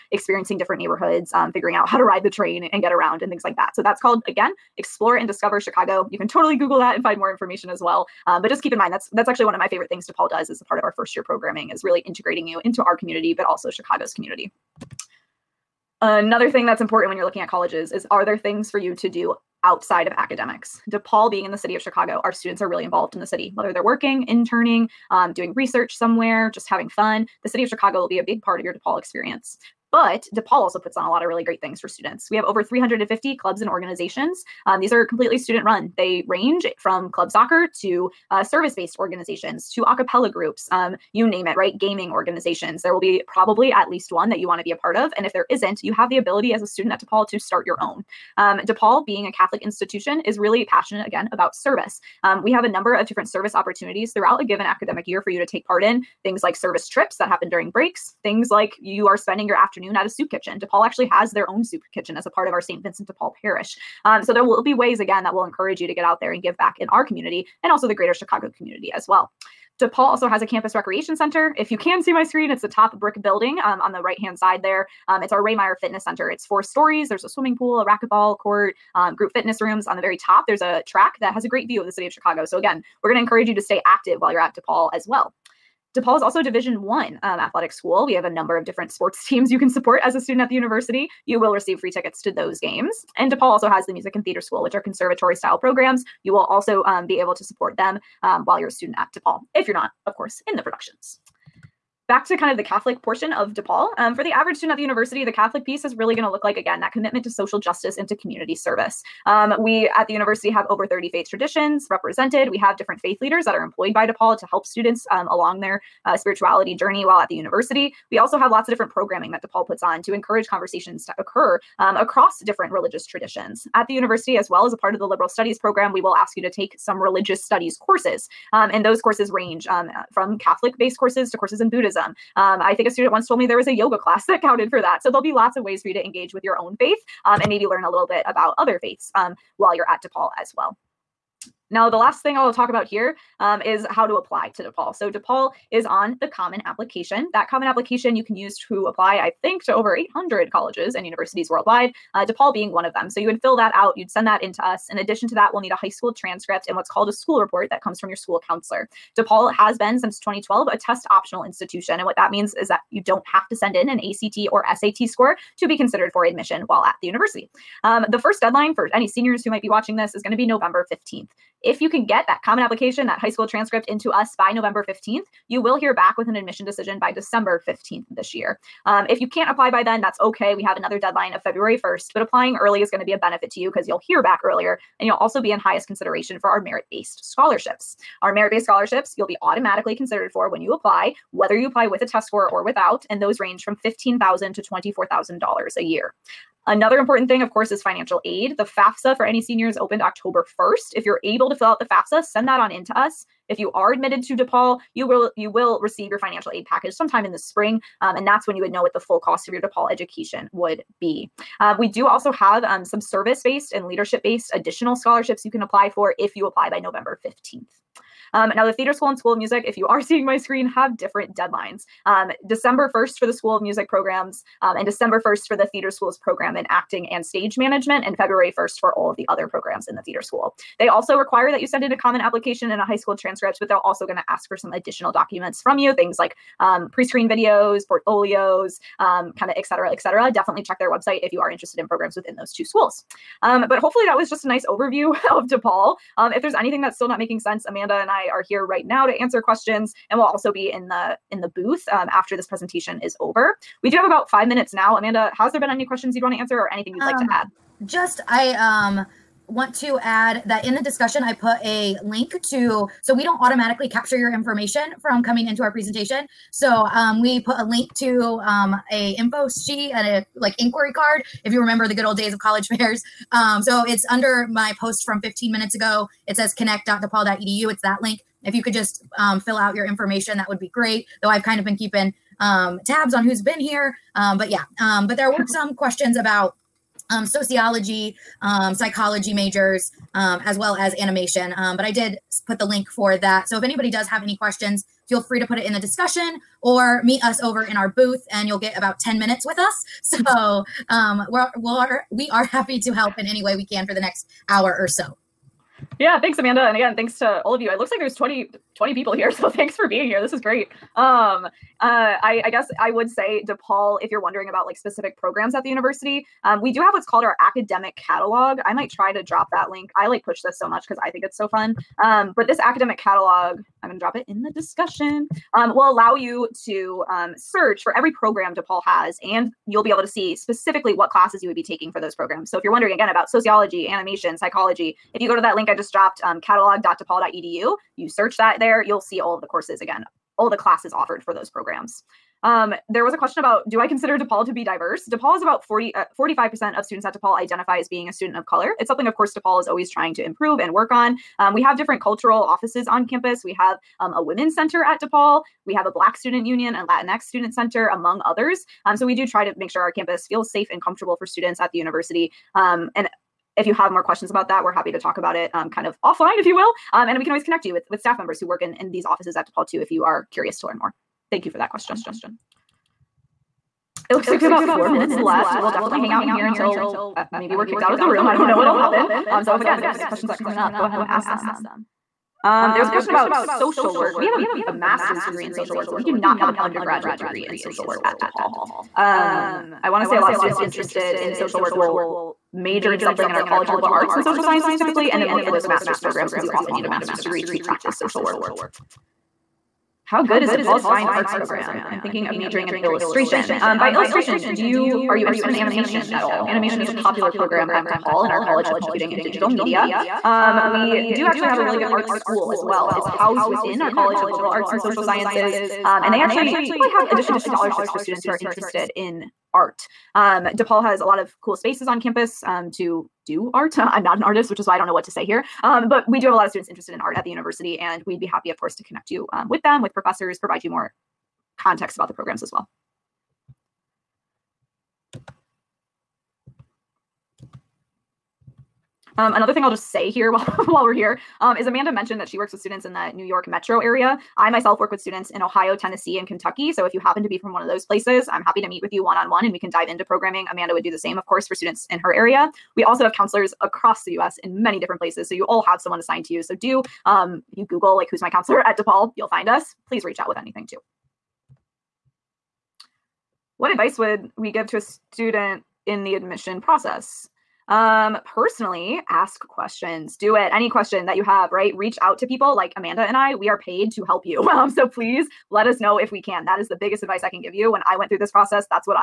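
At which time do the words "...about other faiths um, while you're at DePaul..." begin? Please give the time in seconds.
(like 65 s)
138 s.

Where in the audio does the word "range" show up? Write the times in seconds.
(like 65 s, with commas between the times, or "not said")
36 s, 129 s, 193 s.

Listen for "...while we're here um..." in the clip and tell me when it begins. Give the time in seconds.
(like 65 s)
440 s.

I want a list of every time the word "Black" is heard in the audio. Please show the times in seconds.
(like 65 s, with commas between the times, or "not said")
355 s.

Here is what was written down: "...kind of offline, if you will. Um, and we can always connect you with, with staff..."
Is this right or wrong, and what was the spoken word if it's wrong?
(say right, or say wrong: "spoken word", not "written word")
right.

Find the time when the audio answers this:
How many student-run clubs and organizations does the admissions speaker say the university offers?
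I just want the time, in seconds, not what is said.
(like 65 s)
32 s.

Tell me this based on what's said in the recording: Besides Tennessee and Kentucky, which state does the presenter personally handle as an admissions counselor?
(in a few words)
Ohio.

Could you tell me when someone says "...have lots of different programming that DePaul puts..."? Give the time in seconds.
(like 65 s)
118 s.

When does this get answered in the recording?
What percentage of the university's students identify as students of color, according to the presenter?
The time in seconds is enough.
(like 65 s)
346 s.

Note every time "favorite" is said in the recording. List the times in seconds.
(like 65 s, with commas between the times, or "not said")
9 s.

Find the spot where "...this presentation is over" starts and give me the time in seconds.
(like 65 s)
252 s.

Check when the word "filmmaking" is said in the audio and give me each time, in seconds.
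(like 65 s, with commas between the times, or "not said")
not said.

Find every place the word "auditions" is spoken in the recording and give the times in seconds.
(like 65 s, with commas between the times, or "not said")
not said.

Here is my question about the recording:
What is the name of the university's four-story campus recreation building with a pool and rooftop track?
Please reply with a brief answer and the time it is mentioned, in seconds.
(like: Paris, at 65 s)
Ray Meyer Fitness Center, at 75 s.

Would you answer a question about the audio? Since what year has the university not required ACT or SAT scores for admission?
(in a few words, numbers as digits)
2012.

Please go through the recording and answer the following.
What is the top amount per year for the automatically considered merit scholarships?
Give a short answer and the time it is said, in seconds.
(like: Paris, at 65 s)
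$24,000, at 194 s.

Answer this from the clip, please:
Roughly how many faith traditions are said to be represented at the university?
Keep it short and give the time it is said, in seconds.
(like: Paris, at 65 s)
over 30, at 110 s.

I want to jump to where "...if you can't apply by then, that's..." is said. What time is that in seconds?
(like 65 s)
179 s.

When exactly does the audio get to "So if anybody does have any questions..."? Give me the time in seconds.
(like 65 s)
293 s.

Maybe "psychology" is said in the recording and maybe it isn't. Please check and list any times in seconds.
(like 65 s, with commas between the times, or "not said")
288 s, 334 s.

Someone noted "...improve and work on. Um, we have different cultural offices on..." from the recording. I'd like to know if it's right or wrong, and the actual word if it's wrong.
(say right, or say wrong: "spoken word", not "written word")
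right.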